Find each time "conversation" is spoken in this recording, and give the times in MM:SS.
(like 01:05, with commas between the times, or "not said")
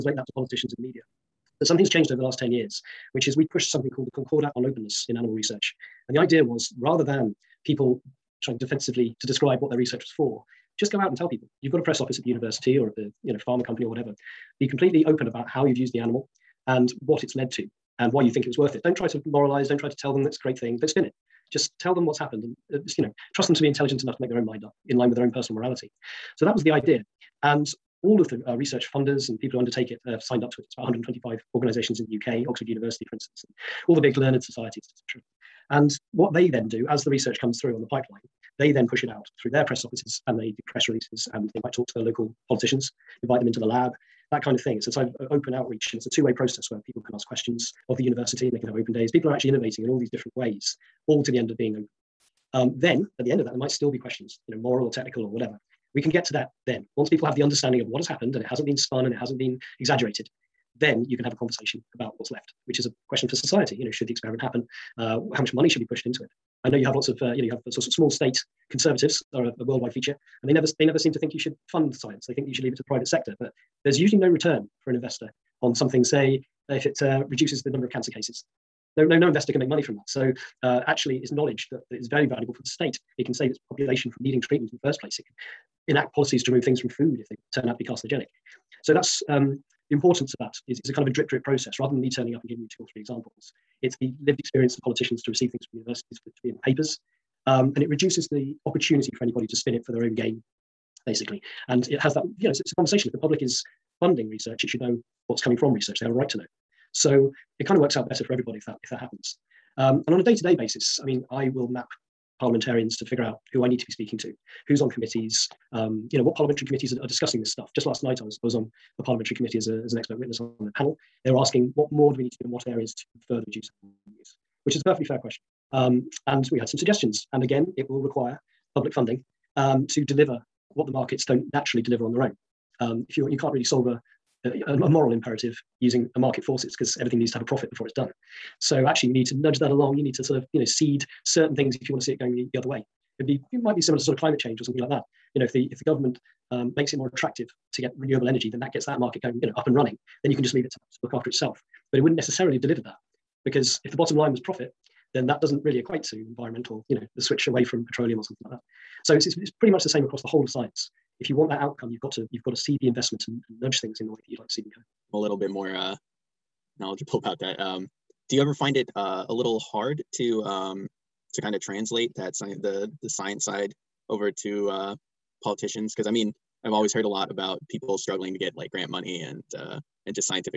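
01:01, 01:42.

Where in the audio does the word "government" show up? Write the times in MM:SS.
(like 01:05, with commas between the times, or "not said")
02:25.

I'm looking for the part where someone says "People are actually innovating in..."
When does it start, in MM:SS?
00:49.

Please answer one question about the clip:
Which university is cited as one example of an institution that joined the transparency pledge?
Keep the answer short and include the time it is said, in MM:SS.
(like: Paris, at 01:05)
Oxford University, at 00:32.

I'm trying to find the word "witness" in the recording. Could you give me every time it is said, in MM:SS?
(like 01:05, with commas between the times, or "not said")
02:00.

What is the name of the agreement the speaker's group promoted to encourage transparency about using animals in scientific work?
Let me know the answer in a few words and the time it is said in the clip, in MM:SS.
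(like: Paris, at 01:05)
Concordat on openness in animal research, at 00:04.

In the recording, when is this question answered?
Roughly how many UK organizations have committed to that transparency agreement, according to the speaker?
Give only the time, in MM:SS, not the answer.
00:30.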